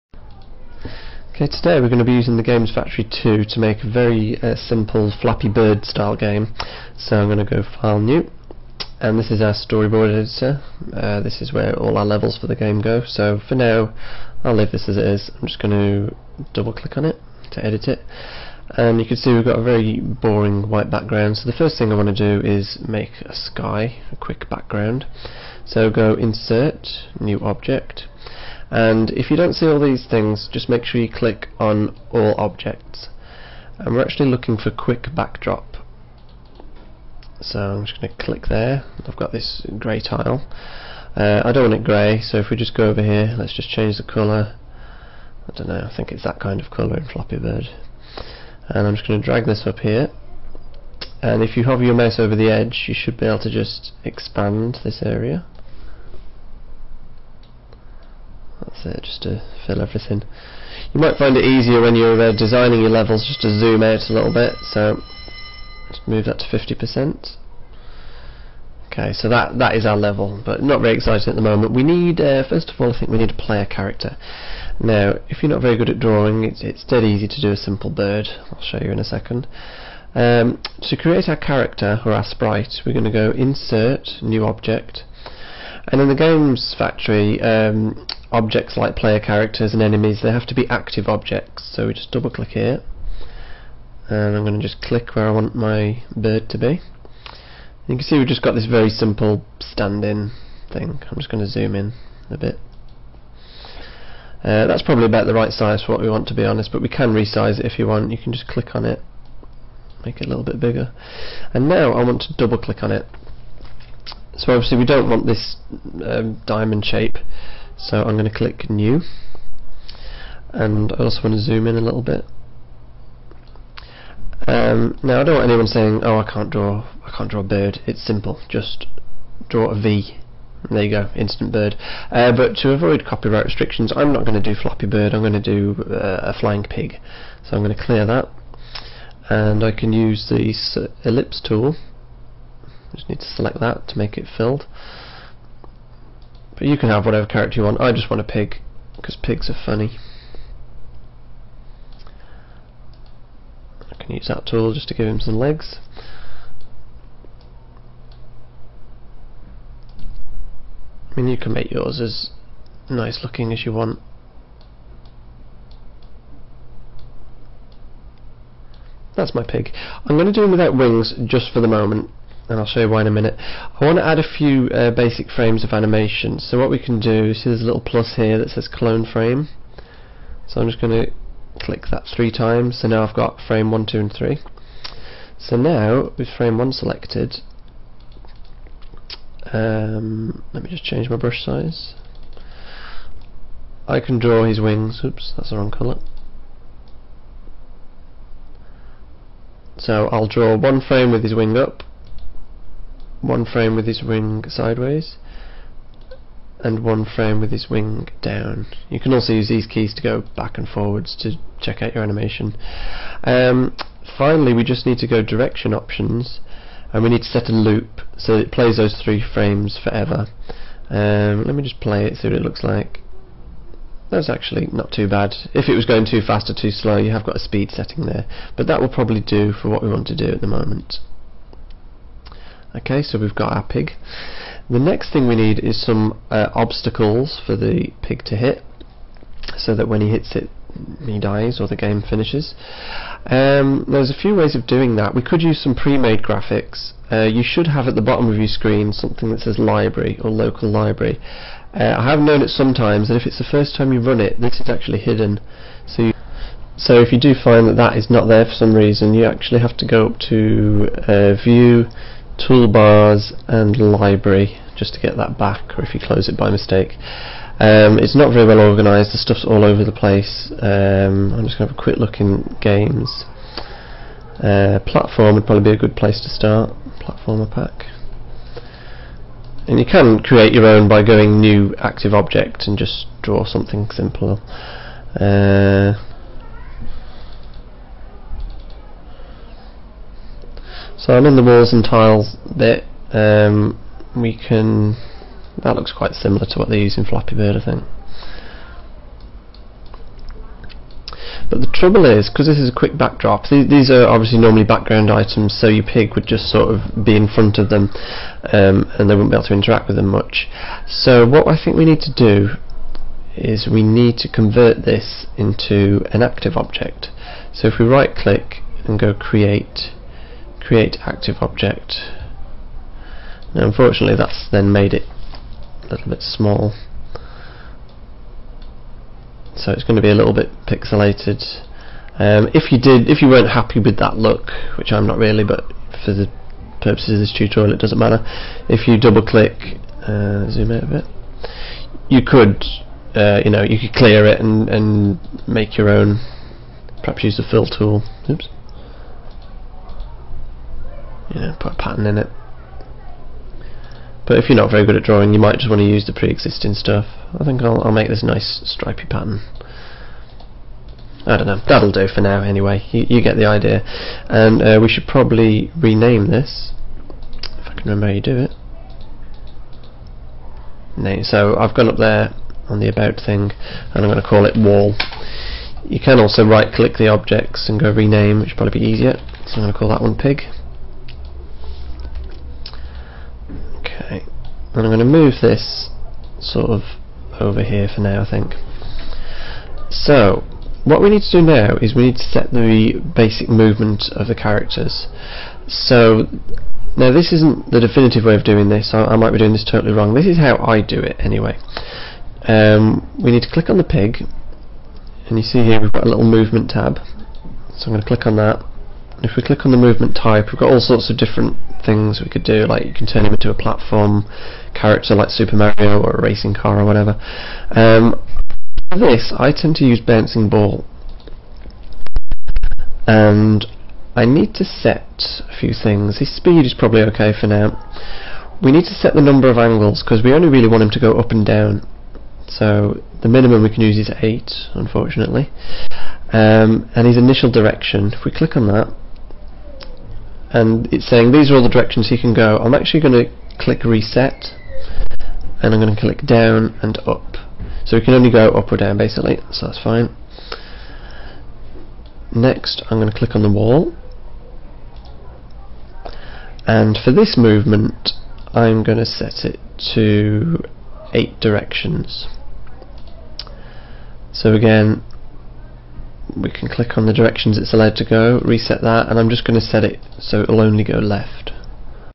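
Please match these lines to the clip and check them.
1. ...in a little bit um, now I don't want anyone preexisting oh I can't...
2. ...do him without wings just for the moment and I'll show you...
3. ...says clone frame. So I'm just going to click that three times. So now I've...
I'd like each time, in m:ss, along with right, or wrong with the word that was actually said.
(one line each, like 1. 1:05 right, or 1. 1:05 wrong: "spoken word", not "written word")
1. 2:01 wrong: "saying", not "preexisting"
2. 2:50 right
3. 2:58 right.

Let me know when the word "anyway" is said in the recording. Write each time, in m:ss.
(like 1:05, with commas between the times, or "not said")
6:02, 6:41.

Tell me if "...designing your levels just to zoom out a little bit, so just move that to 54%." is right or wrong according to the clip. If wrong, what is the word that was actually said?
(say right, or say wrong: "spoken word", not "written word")
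wrong: "50", not "54".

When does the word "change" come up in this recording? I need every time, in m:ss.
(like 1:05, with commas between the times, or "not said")
0:43, 3:10.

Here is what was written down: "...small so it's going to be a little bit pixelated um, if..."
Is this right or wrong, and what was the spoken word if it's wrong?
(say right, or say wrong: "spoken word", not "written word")
right.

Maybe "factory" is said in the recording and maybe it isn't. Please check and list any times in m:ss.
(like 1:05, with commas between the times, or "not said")
0:02, 1:26.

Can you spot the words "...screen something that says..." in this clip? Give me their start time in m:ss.
4:08.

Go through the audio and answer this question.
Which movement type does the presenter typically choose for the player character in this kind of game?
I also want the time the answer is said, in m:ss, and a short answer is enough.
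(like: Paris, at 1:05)
Bouncing ball, at 7:00.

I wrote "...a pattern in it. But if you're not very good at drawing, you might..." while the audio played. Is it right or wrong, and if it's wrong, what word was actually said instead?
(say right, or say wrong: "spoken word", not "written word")
right.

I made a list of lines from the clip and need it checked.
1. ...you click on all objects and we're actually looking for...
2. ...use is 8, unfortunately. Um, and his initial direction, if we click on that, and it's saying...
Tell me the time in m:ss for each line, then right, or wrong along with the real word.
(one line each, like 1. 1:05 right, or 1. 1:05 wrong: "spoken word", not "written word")
1. 0:31 right
2. 7:13 right.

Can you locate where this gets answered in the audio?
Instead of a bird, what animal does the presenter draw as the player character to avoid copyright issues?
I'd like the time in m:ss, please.
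2:16.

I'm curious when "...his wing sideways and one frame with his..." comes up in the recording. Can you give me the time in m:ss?
3:23.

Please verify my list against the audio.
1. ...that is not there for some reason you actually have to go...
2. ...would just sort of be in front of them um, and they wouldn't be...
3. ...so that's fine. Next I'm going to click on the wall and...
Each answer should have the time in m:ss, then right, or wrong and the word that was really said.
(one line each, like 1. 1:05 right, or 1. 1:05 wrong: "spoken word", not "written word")
1. 4:17 right
2. 5:06 right
3. 7:29 right.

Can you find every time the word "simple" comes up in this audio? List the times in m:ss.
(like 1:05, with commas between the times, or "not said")
0:04, 1:17, 1:38, 2:08, 4:43.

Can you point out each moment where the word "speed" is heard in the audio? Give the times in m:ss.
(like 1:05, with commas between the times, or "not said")
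3:47, 7:06.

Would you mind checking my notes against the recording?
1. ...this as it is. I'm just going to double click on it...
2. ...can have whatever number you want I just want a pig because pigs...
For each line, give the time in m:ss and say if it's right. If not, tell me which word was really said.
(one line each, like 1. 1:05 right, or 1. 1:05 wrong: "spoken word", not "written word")
1. 0:14 right
2. 2:26 wrong: "character", not "number".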